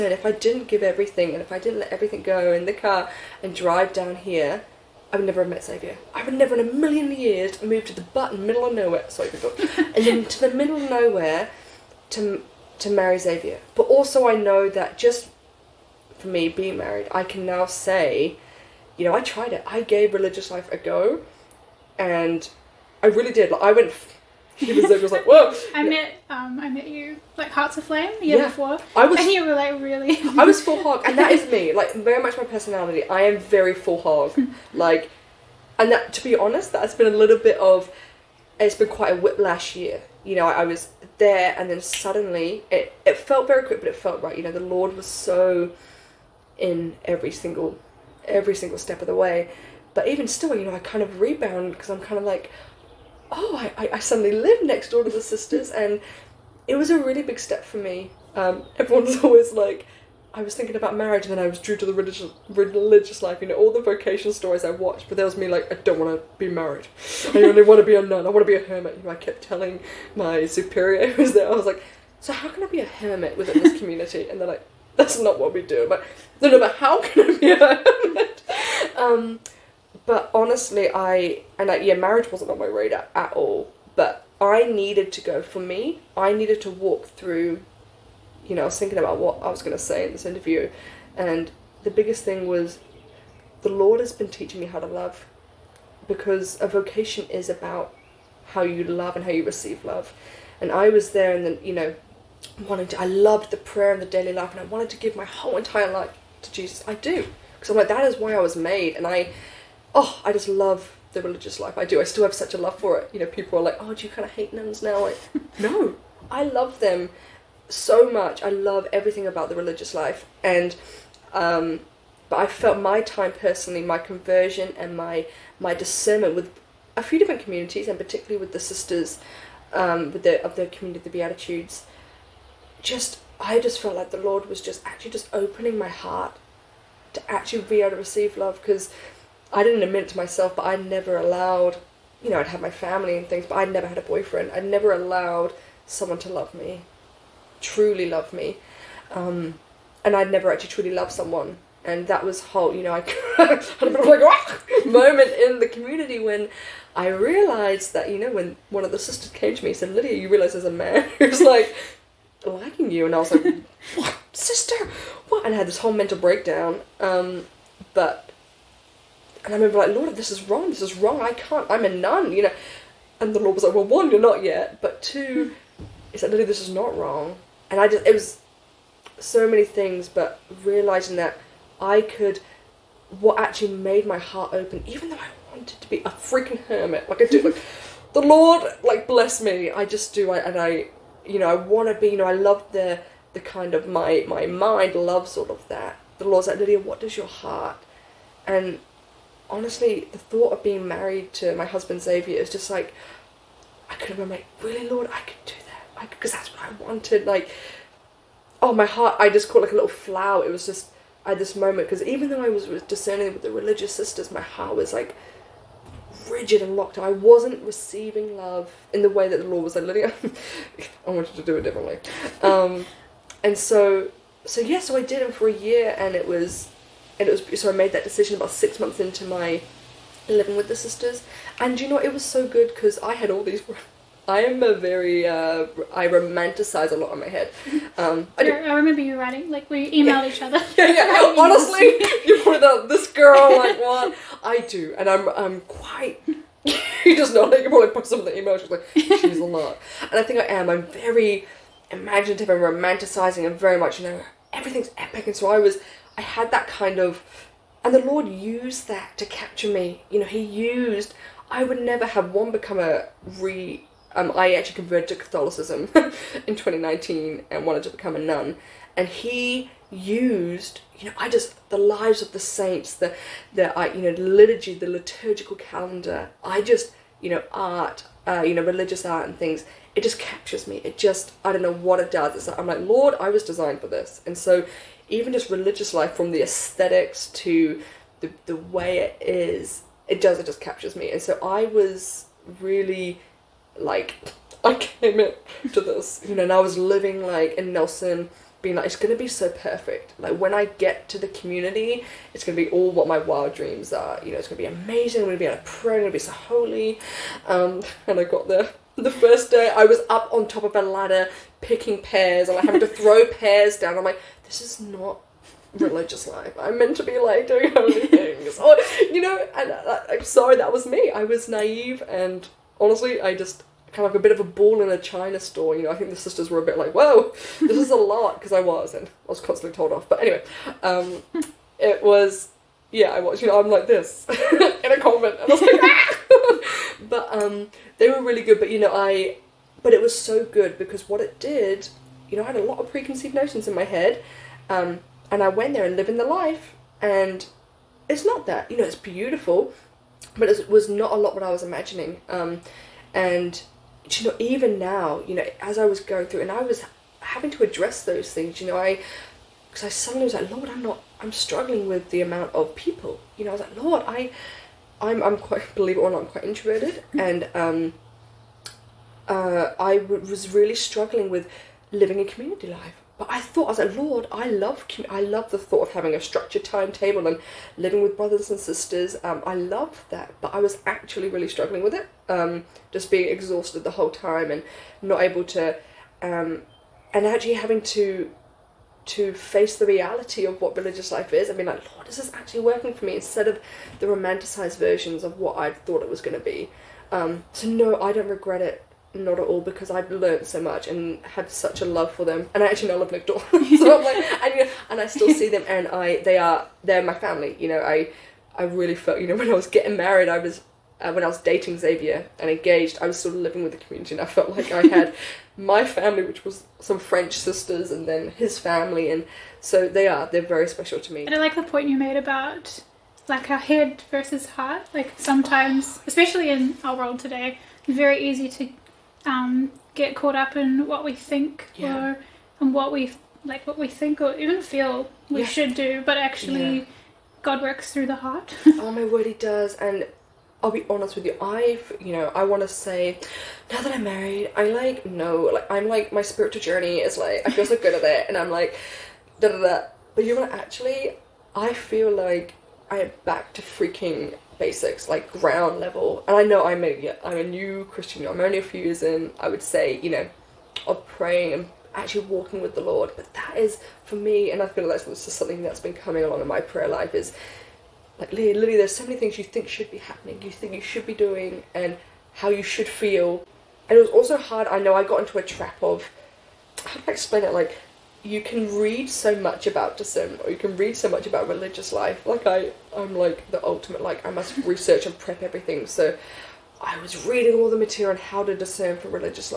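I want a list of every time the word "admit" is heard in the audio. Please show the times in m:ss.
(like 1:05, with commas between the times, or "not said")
2:19.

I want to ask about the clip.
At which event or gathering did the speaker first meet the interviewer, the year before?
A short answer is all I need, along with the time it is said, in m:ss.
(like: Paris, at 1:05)
Hearts Aflame, at 0:27.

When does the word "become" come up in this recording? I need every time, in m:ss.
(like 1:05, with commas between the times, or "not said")
4:22, 4:27.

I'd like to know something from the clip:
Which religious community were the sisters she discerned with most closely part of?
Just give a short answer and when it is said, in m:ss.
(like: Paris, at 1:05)
the Beatitudes, at 2:11.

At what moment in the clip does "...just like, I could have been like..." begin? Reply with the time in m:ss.
3:22.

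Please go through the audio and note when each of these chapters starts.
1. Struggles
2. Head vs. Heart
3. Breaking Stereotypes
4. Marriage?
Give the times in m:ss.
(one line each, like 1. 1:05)
1. 5:52
2. 6:59
3. 3:53
4. 0:54.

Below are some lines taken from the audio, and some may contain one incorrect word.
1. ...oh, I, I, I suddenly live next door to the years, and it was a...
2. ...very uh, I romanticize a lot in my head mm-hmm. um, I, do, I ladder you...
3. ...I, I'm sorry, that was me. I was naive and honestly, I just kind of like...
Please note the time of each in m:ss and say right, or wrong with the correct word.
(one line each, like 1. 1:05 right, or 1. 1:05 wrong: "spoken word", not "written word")
1. 0:53 wrong: "sisters", not "years"
2. 3:54 wrong: "remember", not "ladder"
3. 5:19 right.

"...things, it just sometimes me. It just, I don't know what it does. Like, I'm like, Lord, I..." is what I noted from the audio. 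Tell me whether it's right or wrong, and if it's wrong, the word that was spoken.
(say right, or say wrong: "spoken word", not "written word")
wrong: "captures", not "sometimes".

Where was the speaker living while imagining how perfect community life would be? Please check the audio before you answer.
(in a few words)
Nelson.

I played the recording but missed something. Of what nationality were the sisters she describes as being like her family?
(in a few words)
French.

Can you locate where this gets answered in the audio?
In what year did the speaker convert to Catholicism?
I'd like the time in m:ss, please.
4:26.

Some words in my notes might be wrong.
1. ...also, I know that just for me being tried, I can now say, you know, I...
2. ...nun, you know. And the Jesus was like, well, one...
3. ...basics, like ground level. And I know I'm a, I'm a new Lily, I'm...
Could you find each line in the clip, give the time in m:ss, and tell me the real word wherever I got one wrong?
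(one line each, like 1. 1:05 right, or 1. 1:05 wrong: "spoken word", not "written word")
1. 0:13 wrong: "married", not "tried"
2. 2:51 wrong: "Lord", not "Jesus"
3. 7:34 wrong: "Christian", not "Lily".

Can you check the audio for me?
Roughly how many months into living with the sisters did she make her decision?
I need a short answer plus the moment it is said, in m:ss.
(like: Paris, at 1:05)
6, at 3:48.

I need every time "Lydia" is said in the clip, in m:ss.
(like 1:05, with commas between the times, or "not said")
2:39, 3:16, 3:39.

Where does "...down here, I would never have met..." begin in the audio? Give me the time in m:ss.
0:03.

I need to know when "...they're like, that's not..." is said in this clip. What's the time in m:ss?
1:14.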